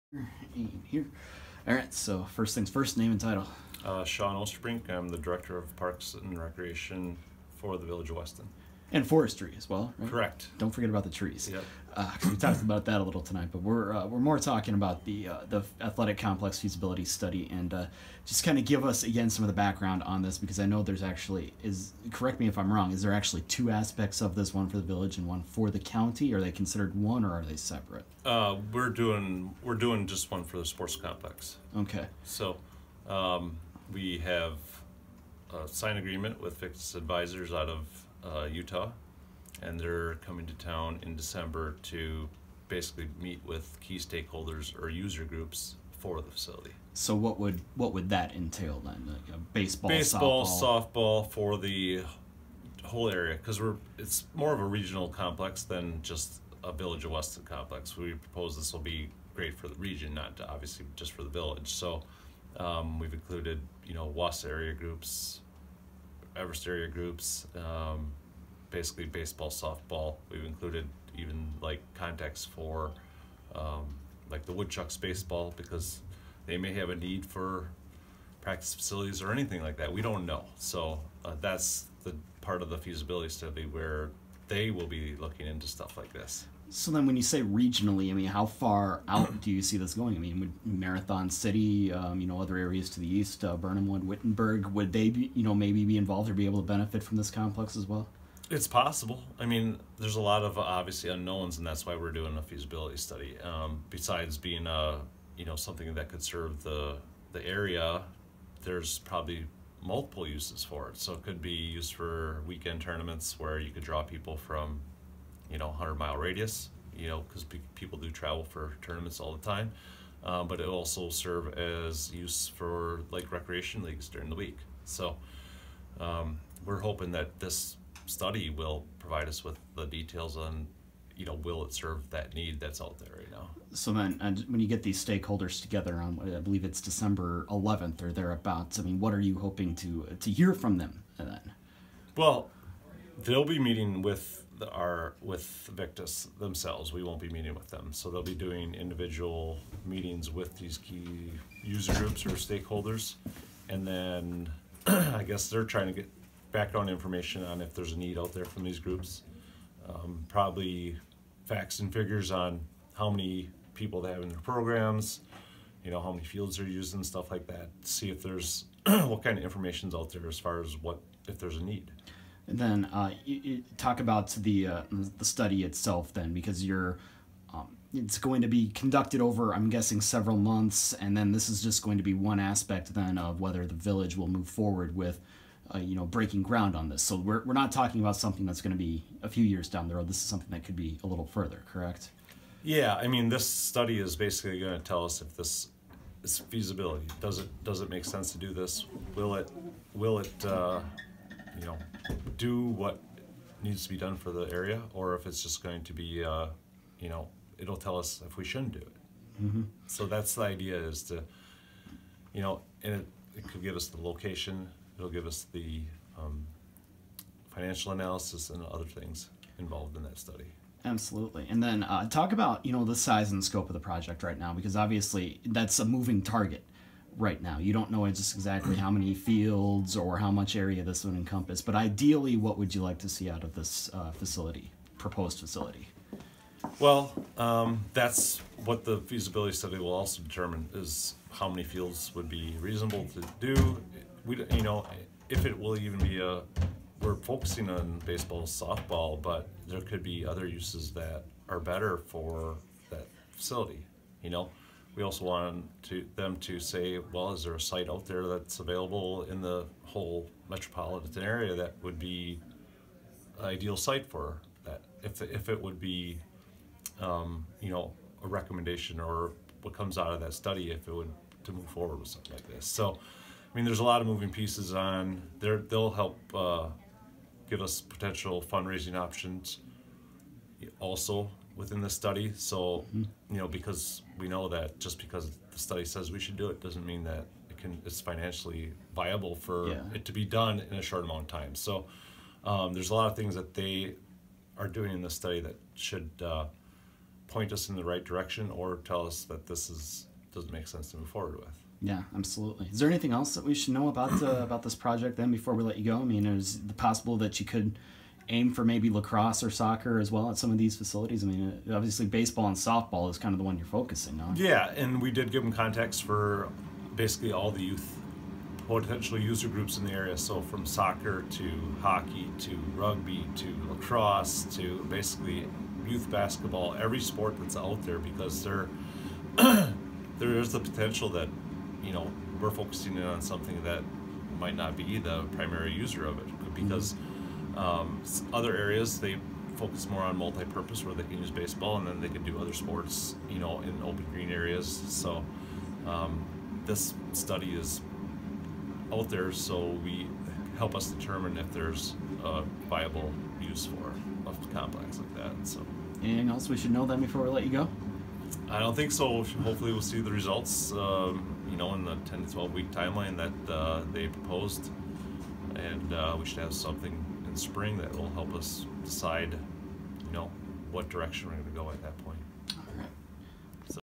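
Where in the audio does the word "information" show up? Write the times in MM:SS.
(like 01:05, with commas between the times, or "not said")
02:36, 02:49.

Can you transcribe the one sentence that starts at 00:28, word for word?
Uh, we're doing we're doing just one for the sports complex.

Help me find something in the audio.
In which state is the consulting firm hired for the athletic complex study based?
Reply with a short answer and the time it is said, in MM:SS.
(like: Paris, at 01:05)
Utah, at 00:38.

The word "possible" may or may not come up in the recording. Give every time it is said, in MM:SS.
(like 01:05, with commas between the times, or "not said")
01:38, 05:06.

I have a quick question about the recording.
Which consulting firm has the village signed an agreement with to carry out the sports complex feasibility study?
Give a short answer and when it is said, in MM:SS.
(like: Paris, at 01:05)
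Victus Advisors, at 00:36.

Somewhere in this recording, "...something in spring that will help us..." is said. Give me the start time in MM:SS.
06:06.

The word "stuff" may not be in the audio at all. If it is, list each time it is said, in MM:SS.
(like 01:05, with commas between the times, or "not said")
01:25, 02:47.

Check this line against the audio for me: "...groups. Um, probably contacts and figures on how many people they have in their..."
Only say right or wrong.
wrong.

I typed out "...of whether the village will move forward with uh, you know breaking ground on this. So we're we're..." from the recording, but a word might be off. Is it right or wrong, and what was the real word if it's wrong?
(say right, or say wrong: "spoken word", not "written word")
right.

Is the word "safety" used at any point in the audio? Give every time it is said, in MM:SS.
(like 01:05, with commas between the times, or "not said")
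not said.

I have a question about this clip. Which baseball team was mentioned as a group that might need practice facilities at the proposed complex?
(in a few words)
Woodchucks.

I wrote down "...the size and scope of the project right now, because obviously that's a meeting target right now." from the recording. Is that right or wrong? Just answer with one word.
wrong.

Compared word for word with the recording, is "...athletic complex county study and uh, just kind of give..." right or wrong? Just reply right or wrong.
wrong.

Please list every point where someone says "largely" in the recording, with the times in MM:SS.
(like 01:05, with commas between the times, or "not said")
not said.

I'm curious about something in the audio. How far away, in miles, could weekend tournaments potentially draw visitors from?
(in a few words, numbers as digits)
100 miles.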